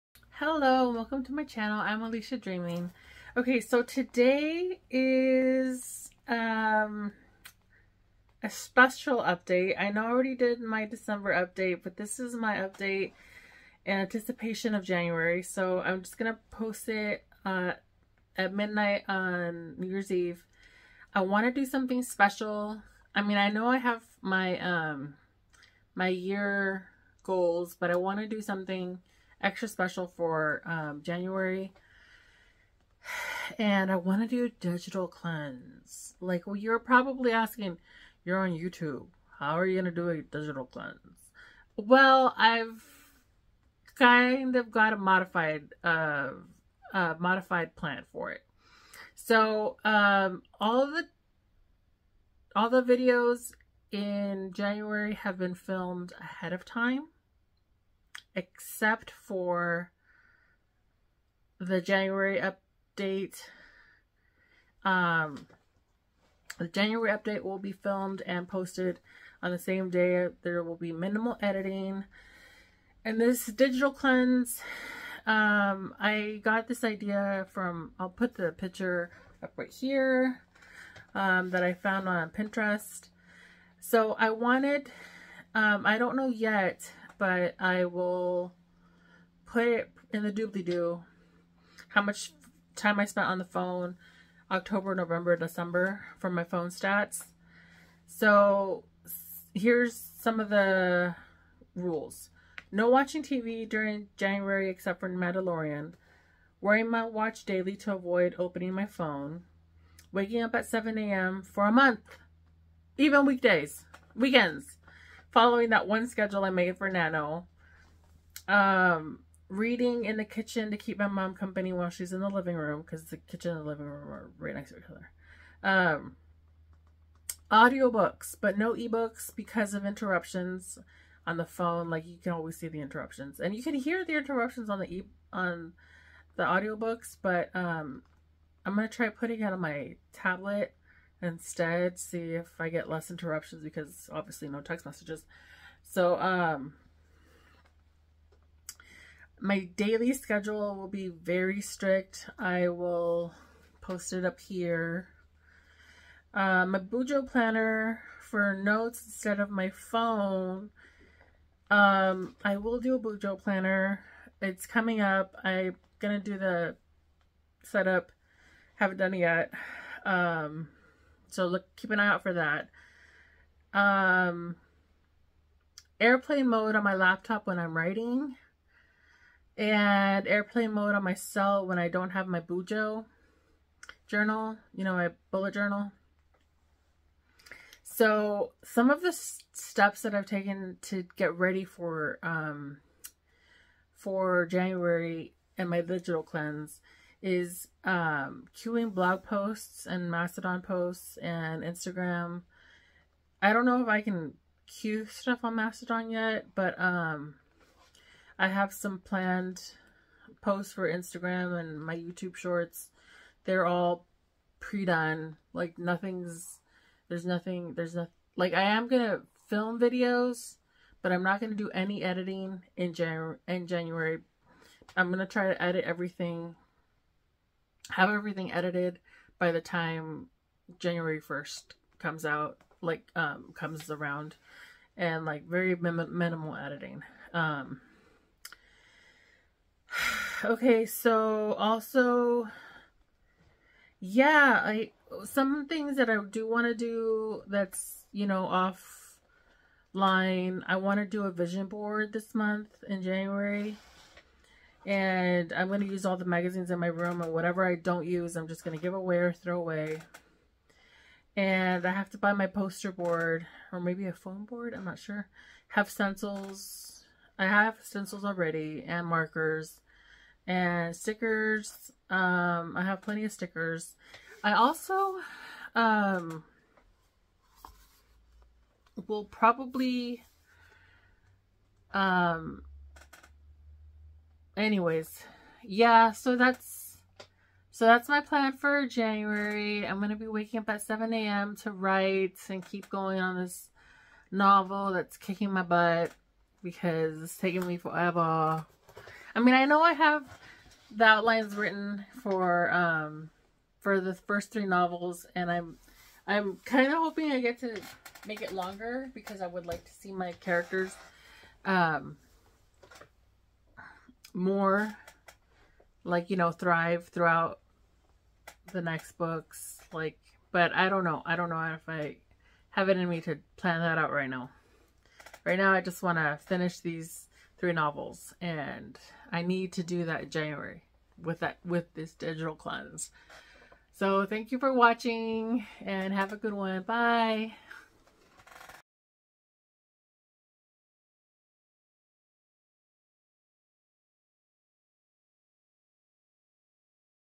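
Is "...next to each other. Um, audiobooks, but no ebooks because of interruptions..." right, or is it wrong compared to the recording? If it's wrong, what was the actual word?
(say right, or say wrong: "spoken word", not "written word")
right.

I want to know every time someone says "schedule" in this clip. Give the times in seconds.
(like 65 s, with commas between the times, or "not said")
116 s, 150 s.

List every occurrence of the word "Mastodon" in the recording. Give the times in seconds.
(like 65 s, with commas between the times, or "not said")
200 s, 205 s.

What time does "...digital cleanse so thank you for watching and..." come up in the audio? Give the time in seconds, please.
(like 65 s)
332 s.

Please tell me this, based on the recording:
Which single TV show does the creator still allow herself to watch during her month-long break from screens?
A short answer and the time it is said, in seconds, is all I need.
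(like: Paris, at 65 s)
Mandalorian, at 105 s.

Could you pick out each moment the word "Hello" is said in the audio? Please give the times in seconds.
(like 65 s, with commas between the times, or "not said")
0 s.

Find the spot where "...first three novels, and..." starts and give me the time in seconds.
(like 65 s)
304 s.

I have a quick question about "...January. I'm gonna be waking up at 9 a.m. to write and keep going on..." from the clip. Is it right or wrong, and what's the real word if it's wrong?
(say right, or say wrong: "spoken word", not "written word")
wrong: "7", not "9".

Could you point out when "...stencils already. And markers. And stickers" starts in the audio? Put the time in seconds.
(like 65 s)
267 s.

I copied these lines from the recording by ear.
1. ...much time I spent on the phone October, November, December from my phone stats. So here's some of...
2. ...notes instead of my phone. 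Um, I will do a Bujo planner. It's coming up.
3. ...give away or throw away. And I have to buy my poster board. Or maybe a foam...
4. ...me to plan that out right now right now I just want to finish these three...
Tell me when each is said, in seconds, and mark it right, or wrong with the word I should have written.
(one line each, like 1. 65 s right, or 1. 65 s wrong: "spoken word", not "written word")
1. 92 s right
2. 158 s right
3. 258 s right
4. 323 s right.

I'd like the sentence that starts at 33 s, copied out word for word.
And I want to do a digital cleanse.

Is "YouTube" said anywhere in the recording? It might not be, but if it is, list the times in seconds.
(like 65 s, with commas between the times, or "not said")
38 s, 211 s.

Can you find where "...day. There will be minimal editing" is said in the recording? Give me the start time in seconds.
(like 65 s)
69 s.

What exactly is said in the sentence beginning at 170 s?
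Um, so look, keep an eye out for that.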